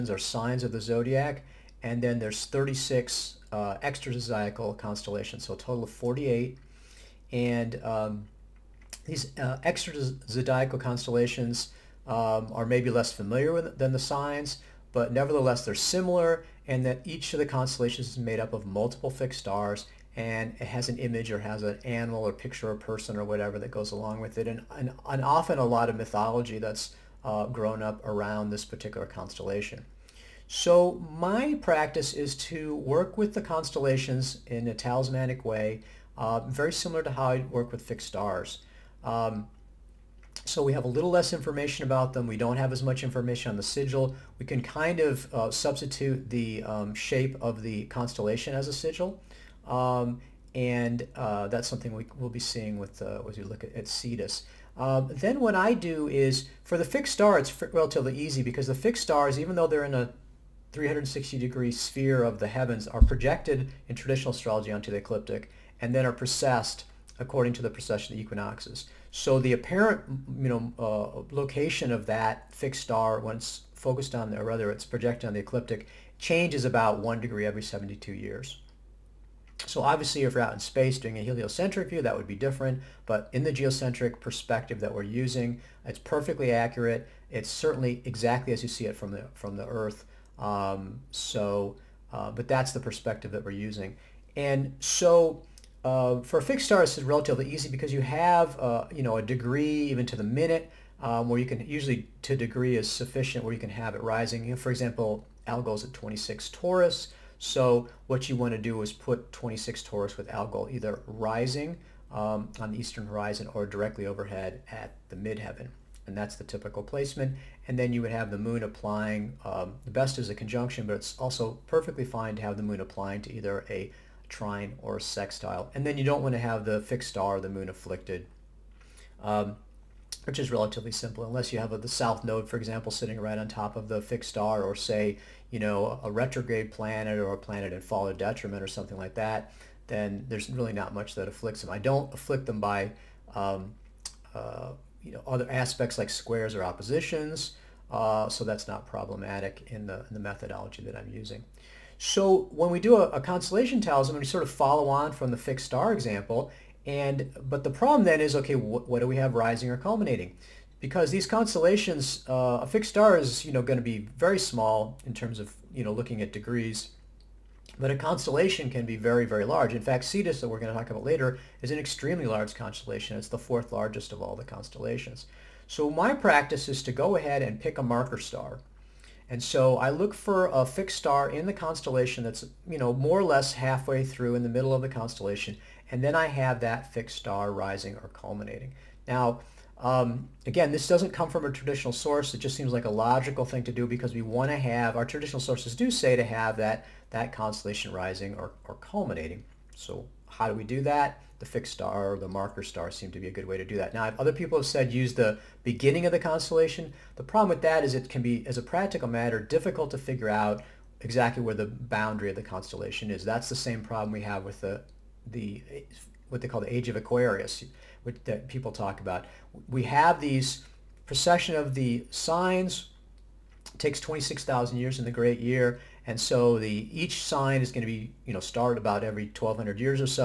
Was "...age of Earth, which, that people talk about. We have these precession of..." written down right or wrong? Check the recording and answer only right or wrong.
wrong.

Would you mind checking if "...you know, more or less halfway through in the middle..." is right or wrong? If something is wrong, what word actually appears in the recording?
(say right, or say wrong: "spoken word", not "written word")
right.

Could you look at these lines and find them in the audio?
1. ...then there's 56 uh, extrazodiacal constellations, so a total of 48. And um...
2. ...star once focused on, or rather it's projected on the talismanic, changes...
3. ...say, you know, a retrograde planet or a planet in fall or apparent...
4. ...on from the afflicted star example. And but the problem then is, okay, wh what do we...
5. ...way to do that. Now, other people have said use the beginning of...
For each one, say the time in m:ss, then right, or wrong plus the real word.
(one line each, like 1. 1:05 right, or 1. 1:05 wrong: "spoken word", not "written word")
1. 0:02 wrong: "36", not "56"
2. 1:12 wrong: "ecliptic", not "talismanic"
3. 2:14 wrong: "detriment", not "apparent"
4. 2:34 wrong: "fixed", not "afflicted"
5. 3:23 right.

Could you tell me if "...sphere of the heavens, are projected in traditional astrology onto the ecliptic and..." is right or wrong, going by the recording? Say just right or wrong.
right.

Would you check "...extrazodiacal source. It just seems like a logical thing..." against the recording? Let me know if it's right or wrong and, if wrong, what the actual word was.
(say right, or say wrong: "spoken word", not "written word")
wrong: "traditional", not "extrazodiacal".